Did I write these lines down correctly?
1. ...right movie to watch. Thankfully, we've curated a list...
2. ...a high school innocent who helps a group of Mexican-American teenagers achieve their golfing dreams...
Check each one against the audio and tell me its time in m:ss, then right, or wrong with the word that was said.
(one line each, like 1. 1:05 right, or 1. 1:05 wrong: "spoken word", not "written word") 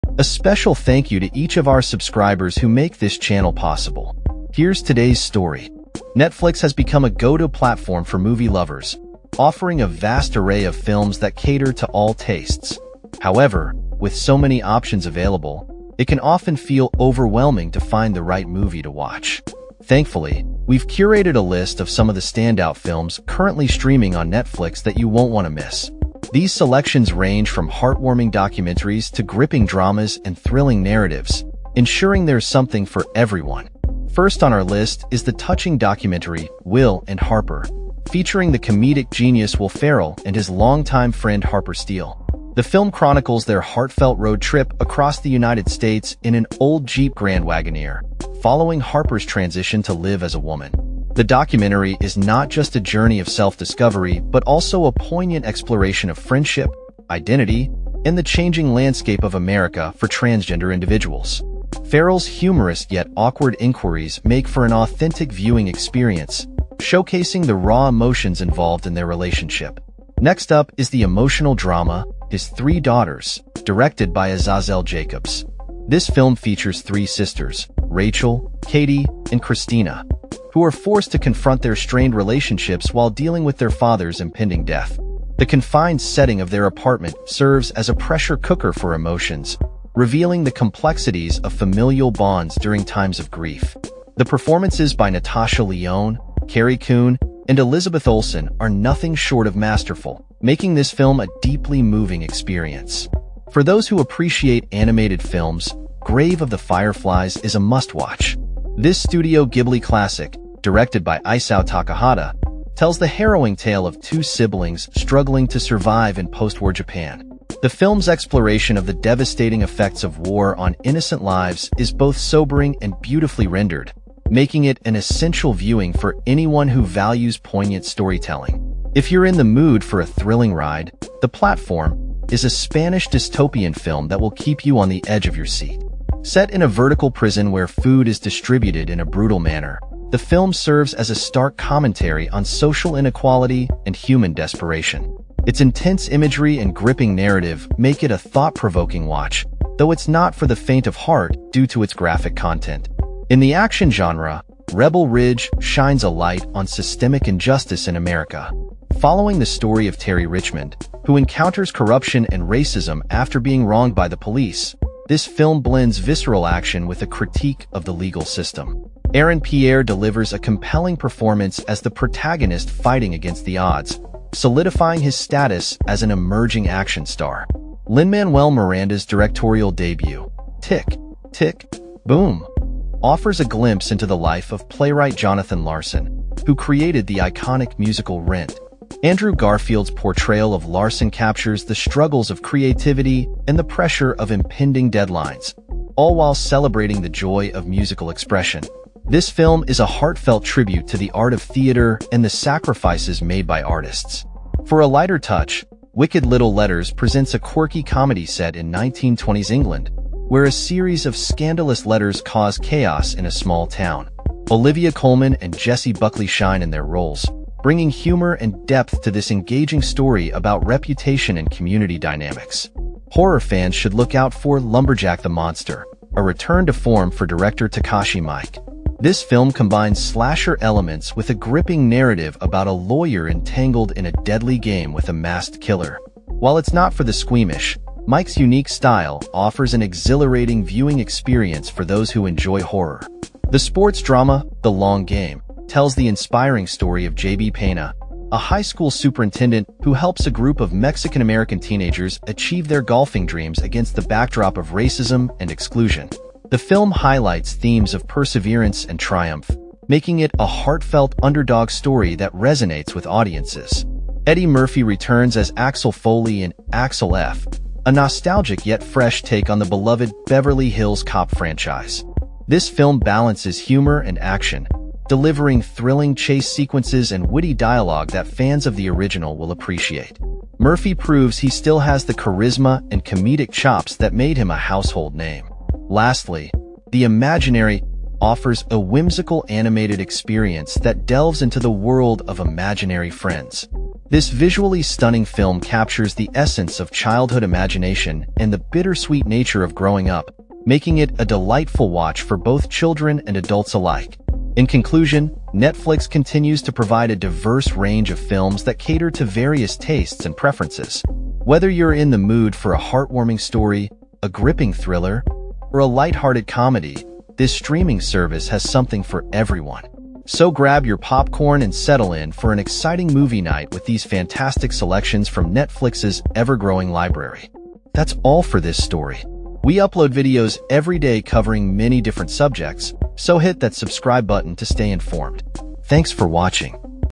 1. 0:18 right
2. 4:08 wrong: "superintendent", not "innocent".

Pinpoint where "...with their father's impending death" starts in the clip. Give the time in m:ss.
1:23.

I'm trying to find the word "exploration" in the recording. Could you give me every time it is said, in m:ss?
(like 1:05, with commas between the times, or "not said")
0:55, 1:58.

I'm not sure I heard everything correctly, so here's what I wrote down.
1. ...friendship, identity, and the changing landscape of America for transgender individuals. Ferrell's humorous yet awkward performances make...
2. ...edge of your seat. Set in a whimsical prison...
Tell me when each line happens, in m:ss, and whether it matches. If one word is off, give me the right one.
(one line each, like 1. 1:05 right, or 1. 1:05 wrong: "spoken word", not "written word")
1. 0:56 wrong: "inquiries", not "performances"
2. 2:15 wrong: "vertical", not "whimsical".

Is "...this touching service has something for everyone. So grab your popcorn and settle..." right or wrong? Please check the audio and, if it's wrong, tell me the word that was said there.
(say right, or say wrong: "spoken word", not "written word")
wrong: "streaming", not "touching".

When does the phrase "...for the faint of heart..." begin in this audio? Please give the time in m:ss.
2:30.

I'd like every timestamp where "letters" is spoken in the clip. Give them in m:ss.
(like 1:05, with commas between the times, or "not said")
3:26, 3:31.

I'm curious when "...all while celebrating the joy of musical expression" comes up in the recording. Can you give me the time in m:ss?
3:15.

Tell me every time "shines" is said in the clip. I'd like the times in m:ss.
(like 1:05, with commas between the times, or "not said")
2:35, 3:36.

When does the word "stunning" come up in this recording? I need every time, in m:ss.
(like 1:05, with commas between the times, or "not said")
4:54.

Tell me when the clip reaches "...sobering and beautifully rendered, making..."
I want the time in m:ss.
2:02.